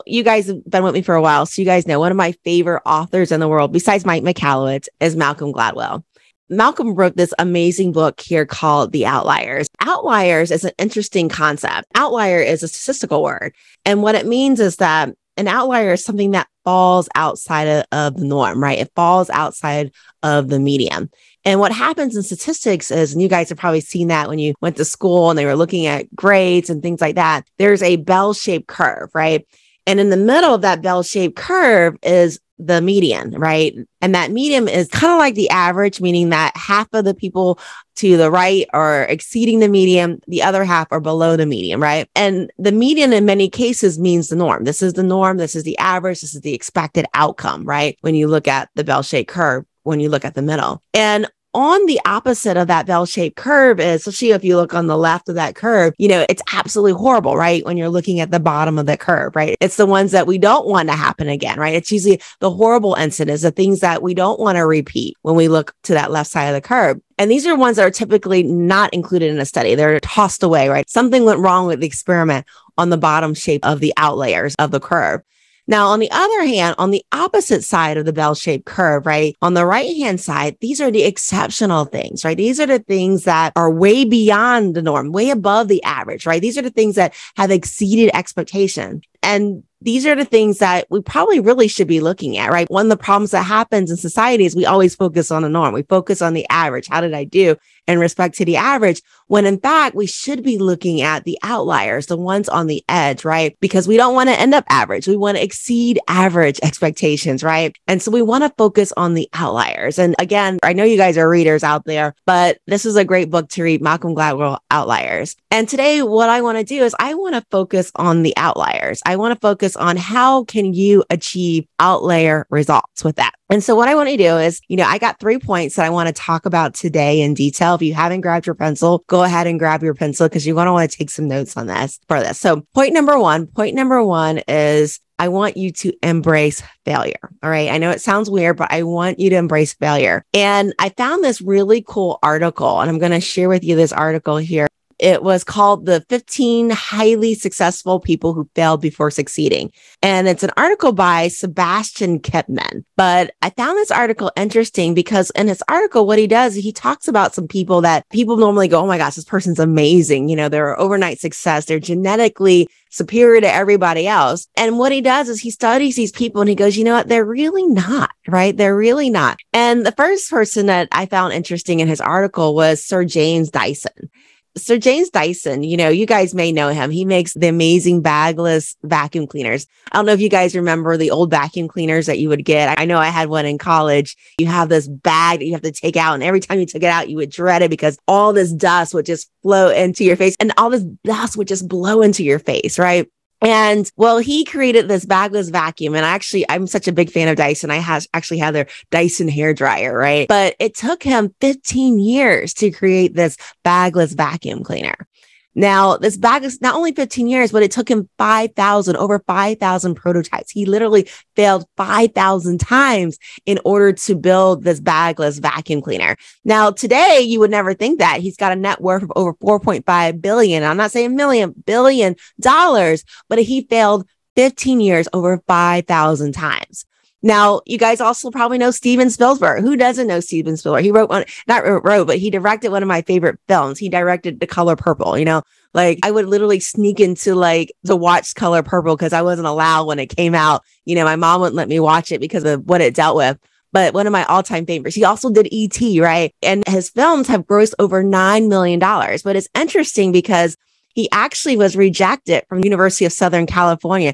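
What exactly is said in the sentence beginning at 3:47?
Now, you guys also probably know Steven Spielberg.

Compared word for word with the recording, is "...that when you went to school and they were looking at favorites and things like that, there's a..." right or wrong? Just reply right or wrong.
wrong.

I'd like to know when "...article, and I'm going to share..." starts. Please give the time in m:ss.
2:22.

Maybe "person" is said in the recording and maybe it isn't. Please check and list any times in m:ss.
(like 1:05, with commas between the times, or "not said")
2:39, 2:50.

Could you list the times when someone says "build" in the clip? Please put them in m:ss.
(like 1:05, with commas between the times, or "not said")
3:34.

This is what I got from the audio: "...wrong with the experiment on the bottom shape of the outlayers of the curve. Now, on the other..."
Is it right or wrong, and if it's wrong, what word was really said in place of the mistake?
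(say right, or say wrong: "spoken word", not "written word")
right.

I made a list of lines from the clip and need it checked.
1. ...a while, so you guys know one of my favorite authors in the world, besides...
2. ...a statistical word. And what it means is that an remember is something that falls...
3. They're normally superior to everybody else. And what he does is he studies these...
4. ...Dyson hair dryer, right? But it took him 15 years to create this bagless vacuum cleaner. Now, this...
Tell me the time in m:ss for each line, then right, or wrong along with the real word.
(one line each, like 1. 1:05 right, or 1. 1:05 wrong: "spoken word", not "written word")
1. 0:01 right
2. 0:12 wrong: "outlier", not "remember"
3. 2:41 wrong: "genetically", not "normally"
4. 3:18 right.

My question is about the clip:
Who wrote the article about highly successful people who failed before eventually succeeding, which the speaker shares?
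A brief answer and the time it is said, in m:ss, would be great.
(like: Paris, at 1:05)
Sebastian Kepman, at 2:31.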